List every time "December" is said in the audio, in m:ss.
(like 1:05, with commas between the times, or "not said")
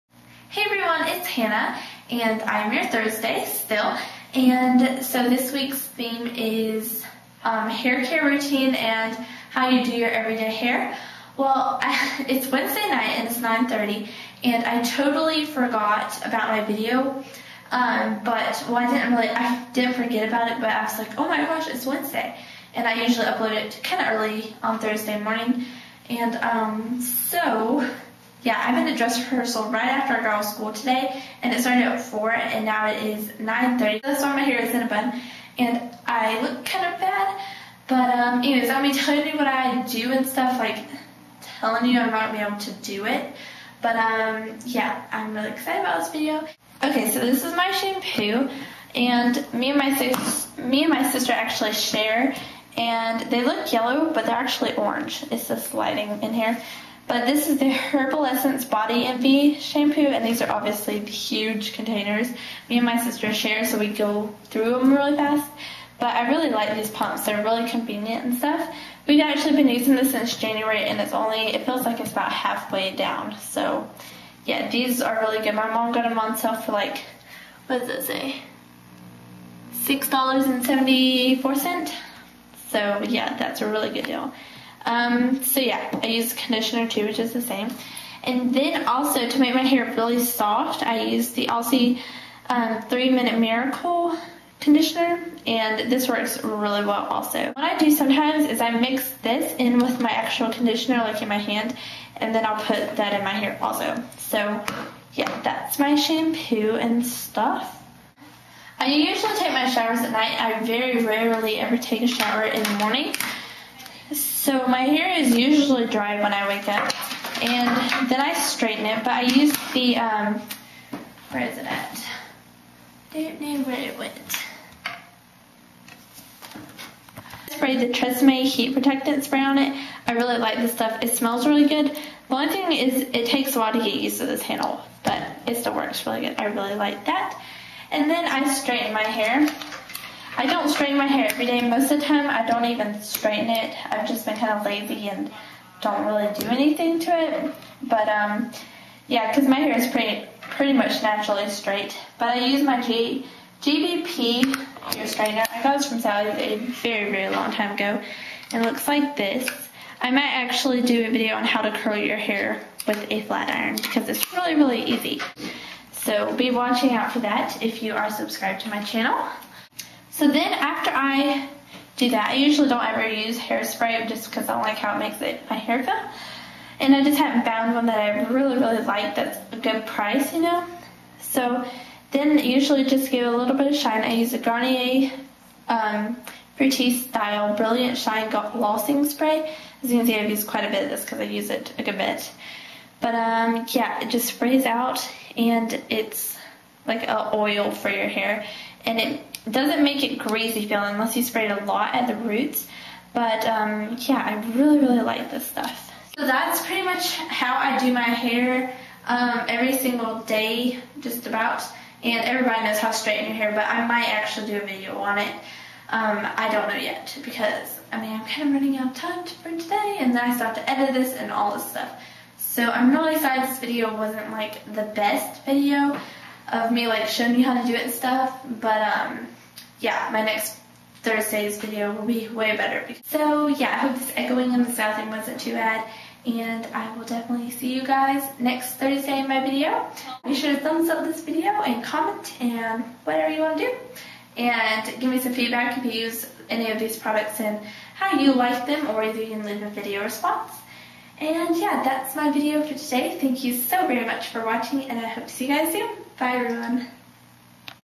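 not said.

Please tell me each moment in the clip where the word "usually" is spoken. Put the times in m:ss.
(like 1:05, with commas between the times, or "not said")
0:23, 1:48, 1:55, 2:52, 3:02.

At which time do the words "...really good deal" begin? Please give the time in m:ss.
1:23.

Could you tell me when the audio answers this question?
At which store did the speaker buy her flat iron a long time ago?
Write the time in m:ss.
2:35.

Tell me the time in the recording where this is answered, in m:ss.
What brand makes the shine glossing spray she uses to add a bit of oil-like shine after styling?
3:04.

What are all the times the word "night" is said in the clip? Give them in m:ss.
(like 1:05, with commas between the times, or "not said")
0:12, 1:50.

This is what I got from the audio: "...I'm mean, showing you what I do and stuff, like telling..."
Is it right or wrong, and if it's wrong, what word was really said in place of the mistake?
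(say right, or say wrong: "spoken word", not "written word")
wrong: "telling", not "showing".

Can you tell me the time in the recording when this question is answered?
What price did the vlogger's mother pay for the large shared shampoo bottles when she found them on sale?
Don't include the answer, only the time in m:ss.
1:19.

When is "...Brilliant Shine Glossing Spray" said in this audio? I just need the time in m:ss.
3:07.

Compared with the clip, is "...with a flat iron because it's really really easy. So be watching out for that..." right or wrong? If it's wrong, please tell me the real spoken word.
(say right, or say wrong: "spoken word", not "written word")
right.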